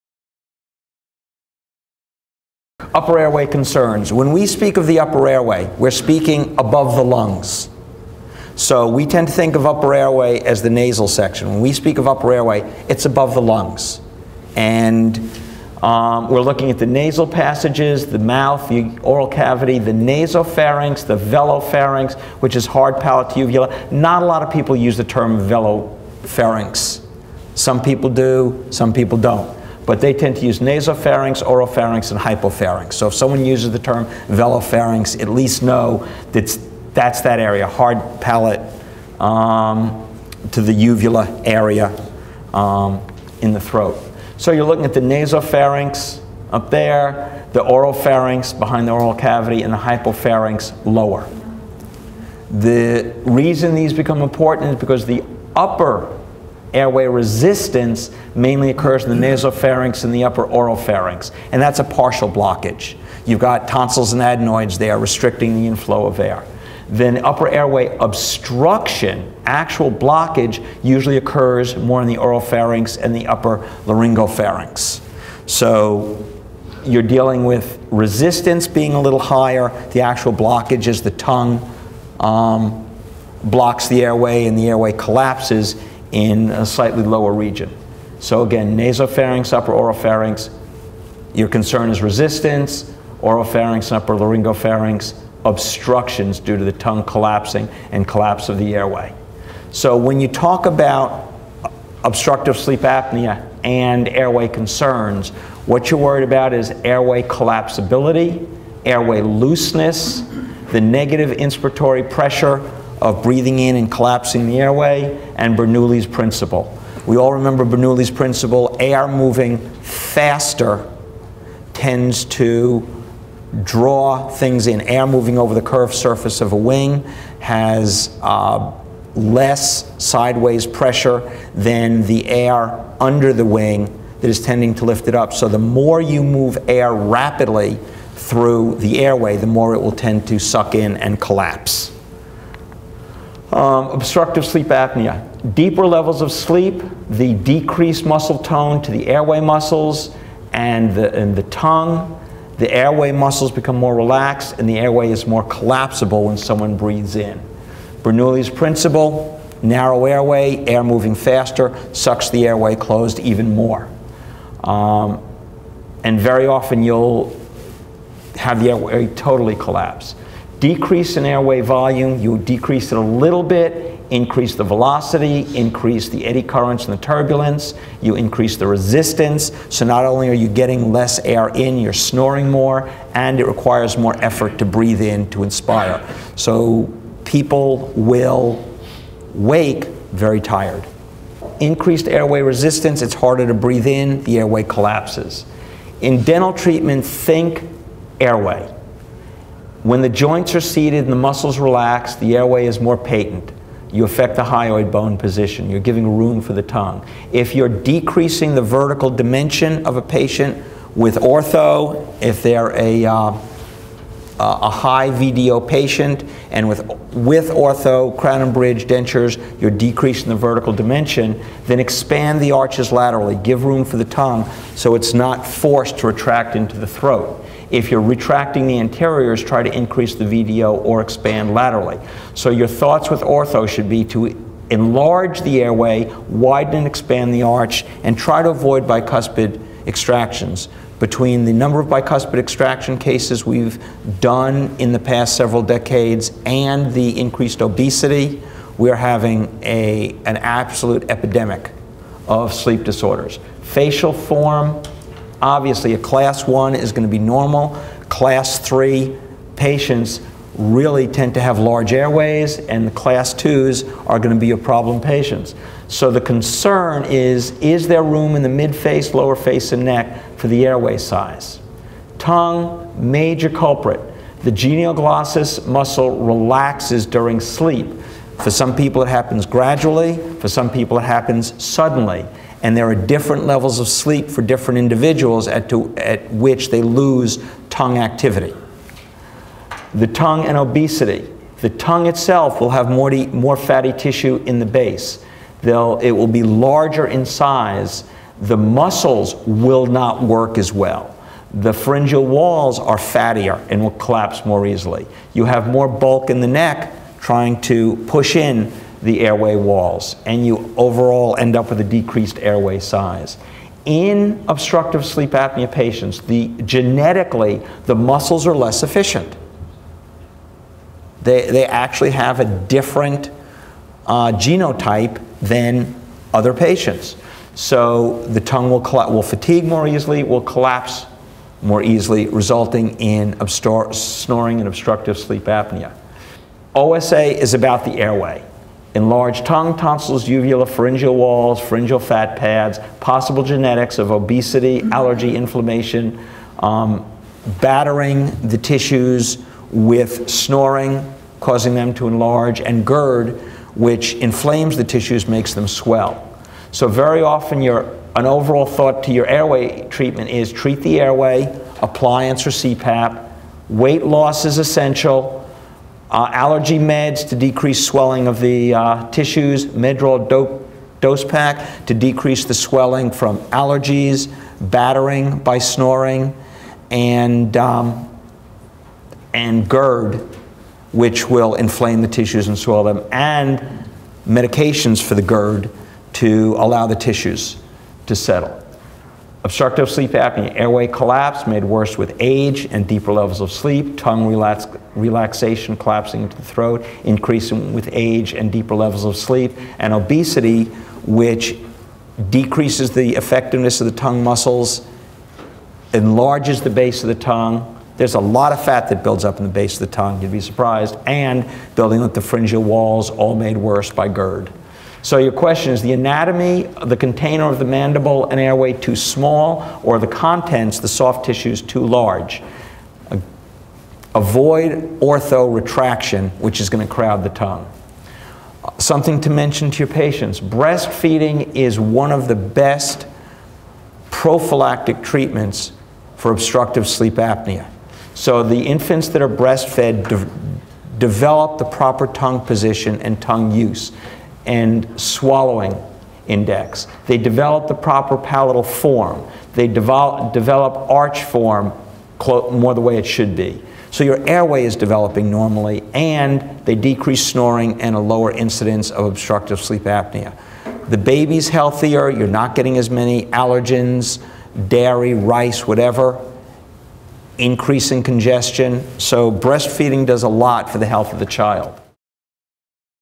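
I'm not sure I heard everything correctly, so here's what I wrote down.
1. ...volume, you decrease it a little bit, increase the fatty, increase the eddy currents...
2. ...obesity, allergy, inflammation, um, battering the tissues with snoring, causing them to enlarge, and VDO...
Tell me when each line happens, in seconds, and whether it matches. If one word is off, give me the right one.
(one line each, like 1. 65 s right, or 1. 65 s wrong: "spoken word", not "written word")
1. 171 s wrong: "velocity", not "fatty"
2. 344 s wrong: "GERD", not "VDO".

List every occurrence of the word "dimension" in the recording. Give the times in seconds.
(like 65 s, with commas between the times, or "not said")
209 s, 220 s.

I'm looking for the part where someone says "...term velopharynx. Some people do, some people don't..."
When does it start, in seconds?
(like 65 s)
25 s.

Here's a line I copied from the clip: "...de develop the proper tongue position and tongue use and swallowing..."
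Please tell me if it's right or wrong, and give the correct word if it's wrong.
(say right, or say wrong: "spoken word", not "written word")
right.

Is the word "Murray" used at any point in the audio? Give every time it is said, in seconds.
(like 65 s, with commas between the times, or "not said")
not said.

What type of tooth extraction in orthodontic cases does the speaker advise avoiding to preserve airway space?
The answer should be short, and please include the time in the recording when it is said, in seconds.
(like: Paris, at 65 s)
bicuspid extractions, at 238 s.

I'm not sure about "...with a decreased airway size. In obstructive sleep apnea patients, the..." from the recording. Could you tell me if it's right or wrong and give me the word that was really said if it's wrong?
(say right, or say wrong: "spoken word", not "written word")
right.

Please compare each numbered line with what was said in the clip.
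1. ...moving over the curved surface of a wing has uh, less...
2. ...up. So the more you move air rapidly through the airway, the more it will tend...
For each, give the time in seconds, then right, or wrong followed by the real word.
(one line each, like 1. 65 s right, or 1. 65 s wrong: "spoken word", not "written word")
1. 125 s right
2. 135 s right.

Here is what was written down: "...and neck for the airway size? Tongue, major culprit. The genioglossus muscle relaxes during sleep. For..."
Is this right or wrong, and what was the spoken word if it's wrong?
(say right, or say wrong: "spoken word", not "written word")
right.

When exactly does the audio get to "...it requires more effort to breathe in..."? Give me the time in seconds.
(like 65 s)
183 s.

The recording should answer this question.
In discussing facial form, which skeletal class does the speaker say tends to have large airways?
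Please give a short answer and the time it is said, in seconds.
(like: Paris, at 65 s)
Class three, at 258 s.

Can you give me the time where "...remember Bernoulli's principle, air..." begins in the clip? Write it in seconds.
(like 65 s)
117 s.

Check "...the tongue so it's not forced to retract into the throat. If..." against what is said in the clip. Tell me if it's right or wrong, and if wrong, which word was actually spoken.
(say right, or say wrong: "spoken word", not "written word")
right.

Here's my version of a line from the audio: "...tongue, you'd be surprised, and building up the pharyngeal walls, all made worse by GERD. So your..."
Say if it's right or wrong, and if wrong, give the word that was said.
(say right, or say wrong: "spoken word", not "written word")
right.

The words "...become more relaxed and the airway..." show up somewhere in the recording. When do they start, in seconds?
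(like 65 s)
153 s.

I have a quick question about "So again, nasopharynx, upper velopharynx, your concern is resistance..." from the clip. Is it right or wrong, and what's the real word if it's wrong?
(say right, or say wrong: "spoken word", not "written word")
wrong: "oropharynx", not "velopharynx".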